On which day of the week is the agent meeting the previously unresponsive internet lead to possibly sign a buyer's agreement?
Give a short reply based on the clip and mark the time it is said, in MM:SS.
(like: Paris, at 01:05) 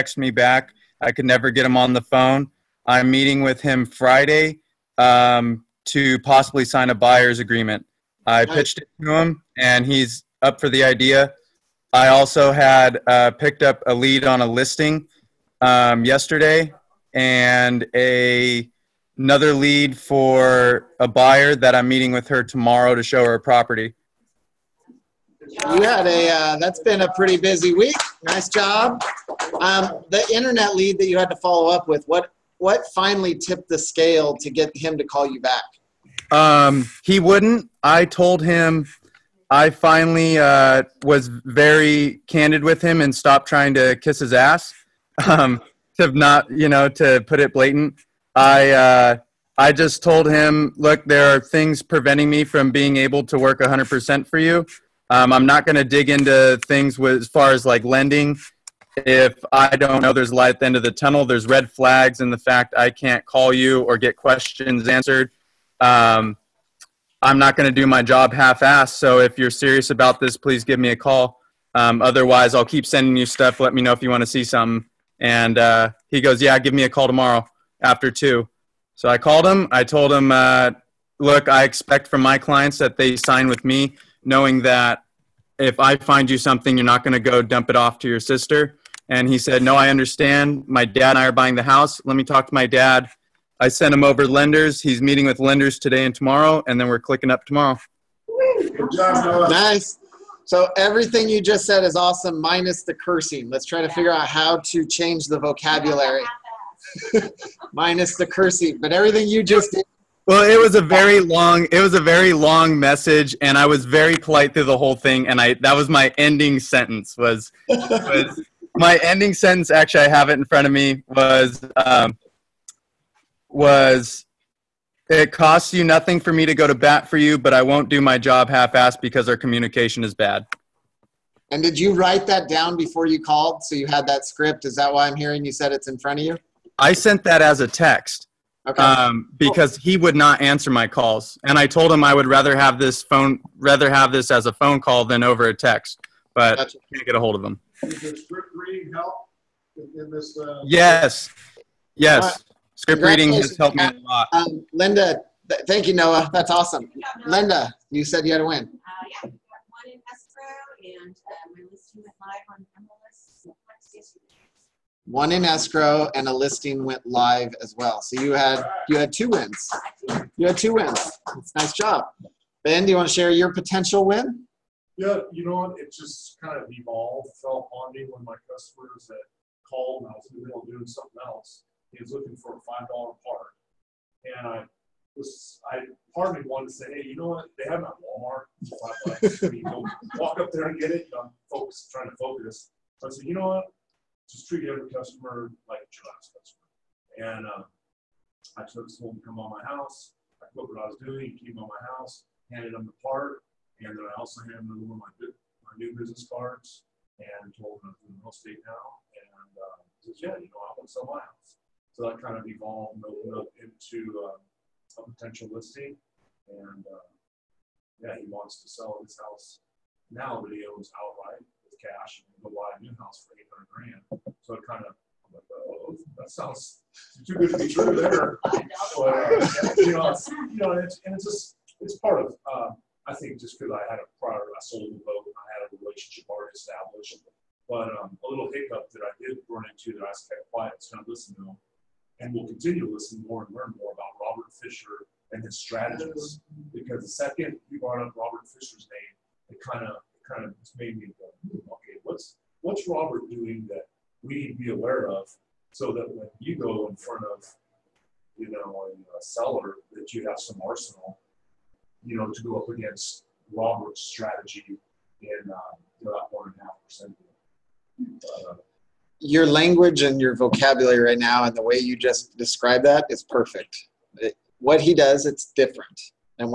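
Friday, at 00:03.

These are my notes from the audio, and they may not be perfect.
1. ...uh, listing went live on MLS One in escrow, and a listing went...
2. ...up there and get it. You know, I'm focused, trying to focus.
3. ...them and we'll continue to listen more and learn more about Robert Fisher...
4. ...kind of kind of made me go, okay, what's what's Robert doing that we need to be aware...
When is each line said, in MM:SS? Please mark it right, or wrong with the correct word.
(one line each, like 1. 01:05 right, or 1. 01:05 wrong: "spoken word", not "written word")
1. 02:41 right
2. 03:10 right
3. 04:01 right
4. 04:09 right.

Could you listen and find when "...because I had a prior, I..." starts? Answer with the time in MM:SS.
03:53.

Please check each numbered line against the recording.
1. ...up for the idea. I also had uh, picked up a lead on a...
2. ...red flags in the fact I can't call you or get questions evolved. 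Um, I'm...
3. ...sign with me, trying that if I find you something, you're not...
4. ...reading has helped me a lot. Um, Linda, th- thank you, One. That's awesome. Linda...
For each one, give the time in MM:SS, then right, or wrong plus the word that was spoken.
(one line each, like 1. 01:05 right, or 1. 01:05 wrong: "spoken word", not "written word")
1. 00:10 right
2. 01:01 wrong: "answered", not "evolved"
3. 01:23 wrong: "knowing", not "trying"
4. 02:33 wrong: "Noah", not "One".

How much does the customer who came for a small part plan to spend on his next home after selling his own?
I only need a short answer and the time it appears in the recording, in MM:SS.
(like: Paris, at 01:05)
$800,000, at 03:43.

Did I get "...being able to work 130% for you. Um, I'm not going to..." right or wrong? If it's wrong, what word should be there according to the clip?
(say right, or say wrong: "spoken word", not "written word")
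wrong: "100", not "130".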